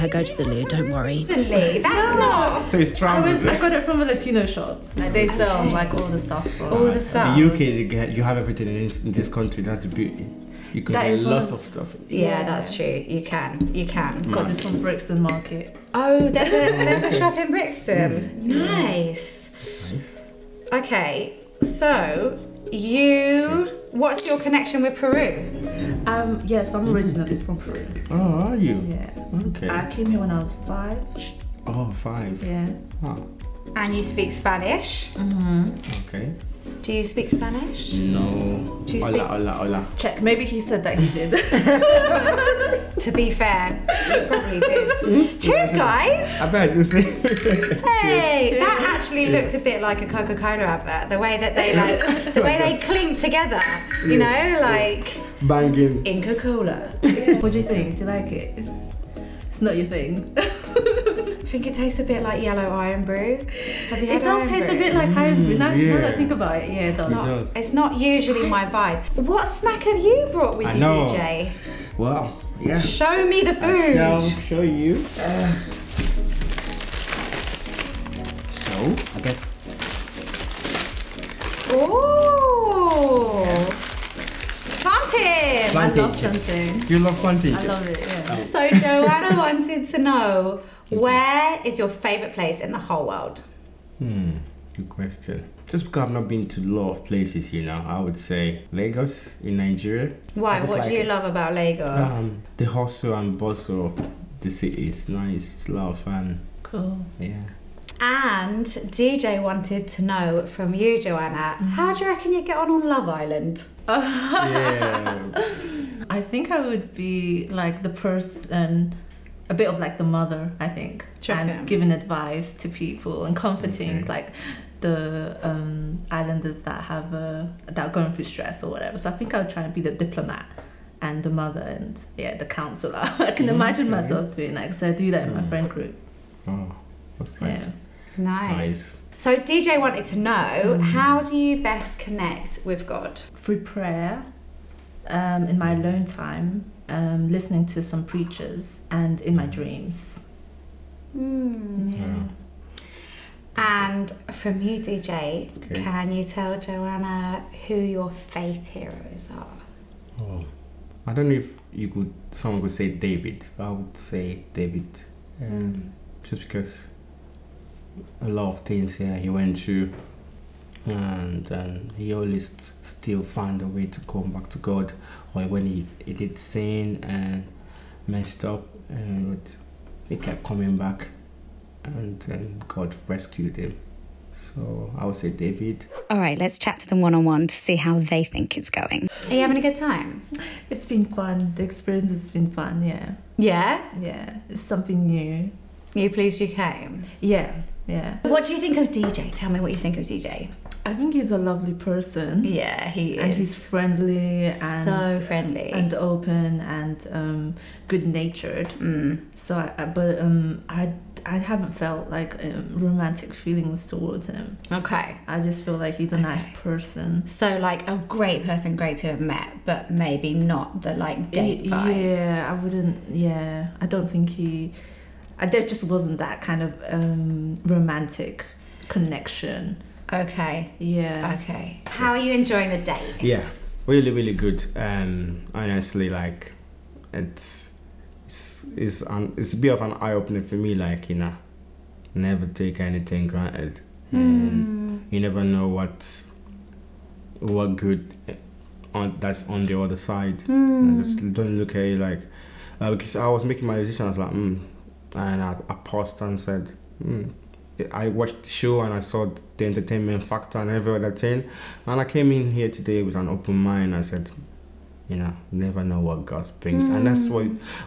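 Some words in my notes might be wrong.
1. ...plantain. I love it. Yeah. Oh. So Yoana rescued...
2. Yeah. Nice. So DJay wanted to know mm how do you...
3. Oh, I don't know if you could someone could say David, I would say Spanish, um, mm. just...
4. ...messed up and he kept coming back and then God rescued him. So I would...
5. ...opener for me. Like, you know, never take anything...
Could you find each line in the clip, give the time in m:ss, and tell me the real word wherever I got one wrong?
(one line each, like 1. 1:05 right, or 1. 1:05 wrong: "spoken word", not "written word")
1. 1:27 wrong: "wanted", not "rescued"
2. 2:17 right
3. 2:40 wrong: "David", not "Spanish"
4. 2:58 right
5. 4:00 right.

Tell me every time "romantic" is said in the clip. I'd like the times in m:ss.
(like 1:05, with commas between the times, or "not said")
3:32, 3:47.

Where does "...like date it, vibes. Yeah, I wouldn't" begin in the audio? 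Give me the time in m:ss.
3:40.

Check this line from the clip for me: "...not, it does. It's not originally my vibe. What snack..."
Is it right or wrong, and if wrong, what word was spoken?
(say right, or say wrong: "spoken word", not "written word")
wrong: "usually", not "originally".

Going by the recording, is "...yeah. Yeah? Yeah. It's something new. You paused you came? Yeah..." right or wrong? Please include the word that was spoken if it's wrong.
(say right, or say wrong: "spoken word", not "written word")
wrong: "pleased", not "paused".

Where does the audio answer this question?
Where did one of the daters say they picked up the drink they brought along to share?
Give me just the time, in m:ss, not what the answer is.
0:14.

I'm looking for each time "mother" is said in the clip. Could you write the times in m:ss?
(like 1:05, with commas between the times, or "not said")
2:00, 2:11.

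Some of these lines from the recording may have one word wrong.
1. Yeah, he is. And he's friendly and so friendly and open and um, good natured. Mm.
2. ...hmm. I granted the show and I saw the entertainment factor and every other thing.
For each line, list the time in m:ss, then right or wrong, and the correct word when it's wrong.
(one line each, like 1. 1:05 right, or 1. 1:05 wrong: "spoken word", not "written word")
1. 3:22 right
2. 4:17 wrong: "watched", not "granted".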